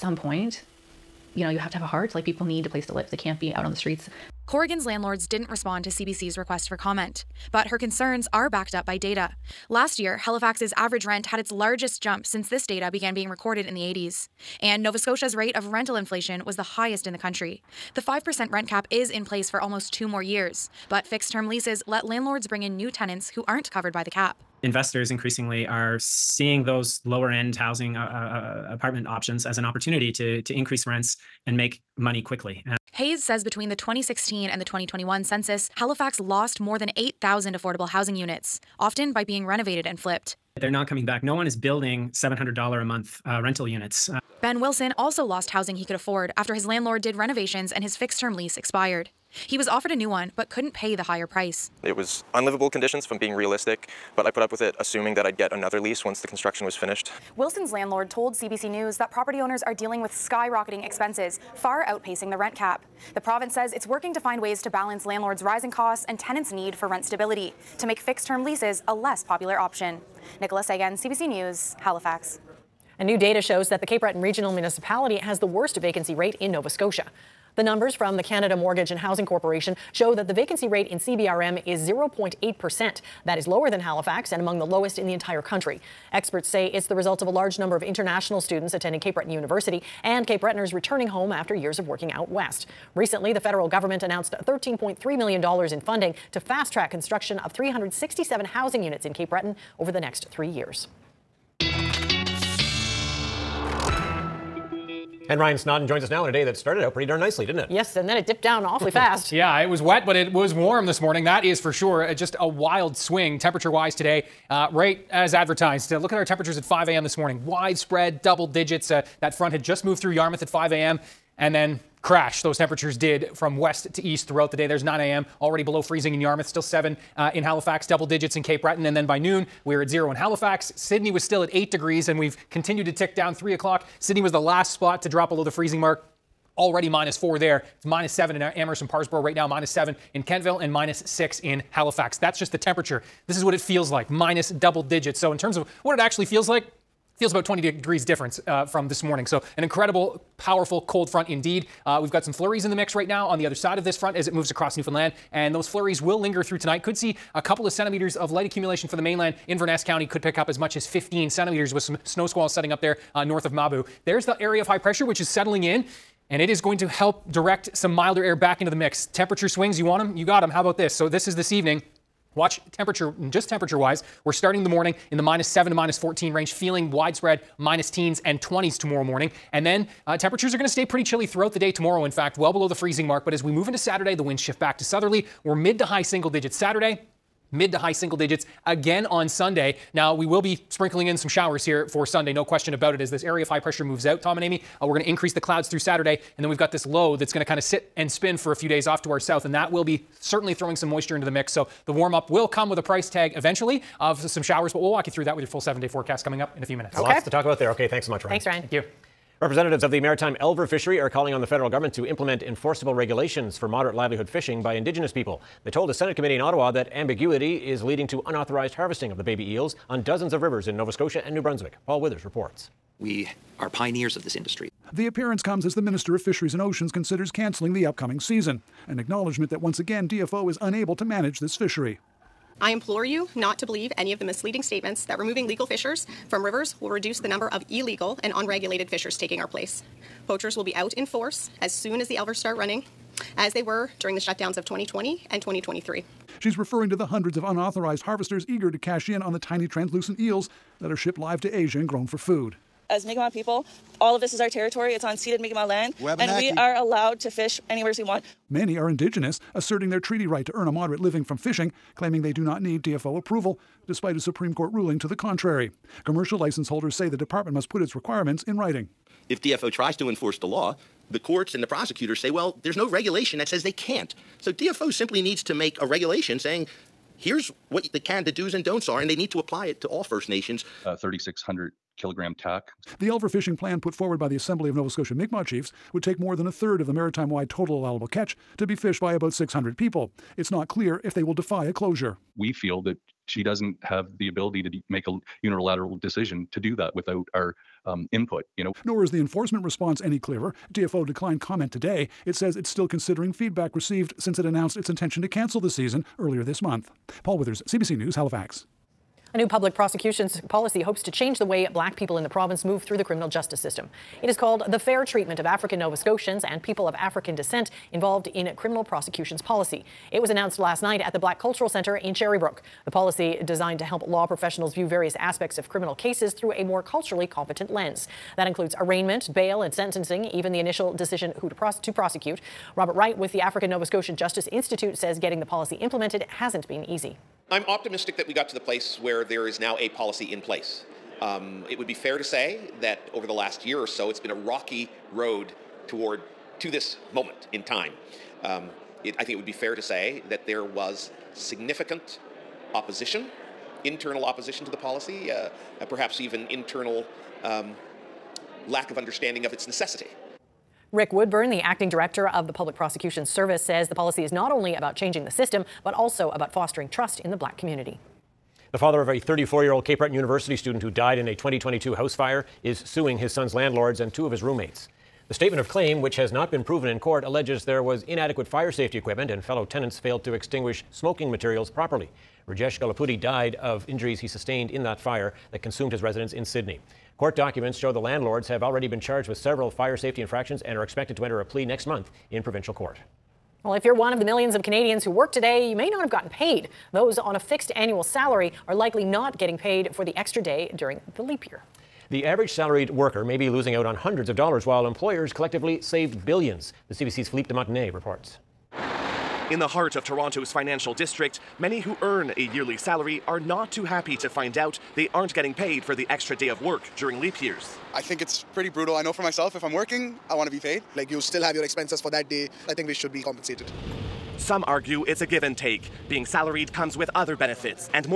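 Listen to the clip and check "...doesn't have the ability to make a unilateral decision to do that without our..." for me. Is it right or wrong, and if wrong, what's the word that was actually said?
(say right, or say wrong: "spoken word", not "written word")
right.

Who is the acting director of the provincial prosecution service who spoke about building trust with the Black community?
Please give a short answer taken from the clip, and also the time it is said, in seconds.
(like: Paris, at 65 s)
Rick Woodburn, at 360 s.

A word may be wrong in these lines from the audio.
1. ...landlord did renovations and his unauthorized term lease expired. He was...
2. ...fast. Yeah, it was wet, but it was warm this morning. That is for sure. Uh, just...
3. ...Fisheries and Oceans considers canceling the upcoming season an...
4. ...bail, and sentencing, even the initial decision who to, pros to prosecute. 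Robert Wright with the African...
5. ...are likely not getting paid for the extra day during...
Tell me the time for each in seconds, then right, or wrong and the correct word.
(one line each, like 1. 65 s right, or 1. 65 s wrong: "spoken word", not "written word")
1. 46 s wrong: "fixed", not "unauthorized"
2. 108 s right
3. 226 s right
4. 329 s right
5. 398 s right.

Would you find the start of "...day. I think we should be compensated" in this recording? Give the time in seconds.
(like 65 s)
422 s.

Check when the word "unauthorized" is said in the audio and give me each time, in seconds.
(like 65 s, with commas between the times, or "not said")
218 s, 247 s.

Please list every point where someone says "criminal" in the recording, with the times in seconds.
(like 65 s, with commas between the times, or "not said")
313 s, 318 s, 325 s.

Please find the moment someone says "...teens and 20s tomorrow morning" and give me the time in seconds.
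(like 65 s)
177 s.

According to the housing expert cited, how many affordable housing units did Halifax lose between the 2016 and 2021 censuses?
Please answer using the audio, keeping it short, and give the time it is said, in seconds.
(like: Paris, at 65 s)
more than 8,000, at 36 s.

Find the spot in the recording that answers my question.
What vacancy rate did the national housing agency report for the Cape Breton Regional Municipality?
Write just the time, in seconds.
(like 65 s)
81 s.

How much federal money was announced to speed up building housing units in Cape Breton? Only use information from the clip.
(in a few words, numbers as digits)
$13.3 million.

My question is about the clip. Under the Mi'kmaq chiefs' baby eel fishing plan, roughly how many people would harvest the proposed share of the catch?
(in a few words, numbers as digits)
about 600.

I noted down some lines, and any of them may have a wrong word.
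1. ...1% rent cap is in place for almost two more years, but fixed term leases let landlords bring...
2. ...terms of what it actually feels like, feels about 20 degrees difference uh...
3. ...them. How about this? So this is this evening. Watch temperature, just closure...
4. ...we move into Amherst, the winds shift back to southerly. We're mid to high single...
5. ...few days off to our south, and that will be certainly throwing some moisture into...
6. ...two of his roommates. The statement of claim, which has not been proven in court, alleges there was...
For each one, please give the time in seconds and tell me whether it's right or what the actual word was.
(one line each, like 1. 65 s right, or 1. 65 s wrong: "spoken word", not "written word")
1. 17 s wrong: "5", not "1"
2. 145 s right
3. 170 s wrong: "temperature", not "closure"
4. 183 s wrong: "Saturday", not "Amherst"
5. 198 s right
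6. 374 s right.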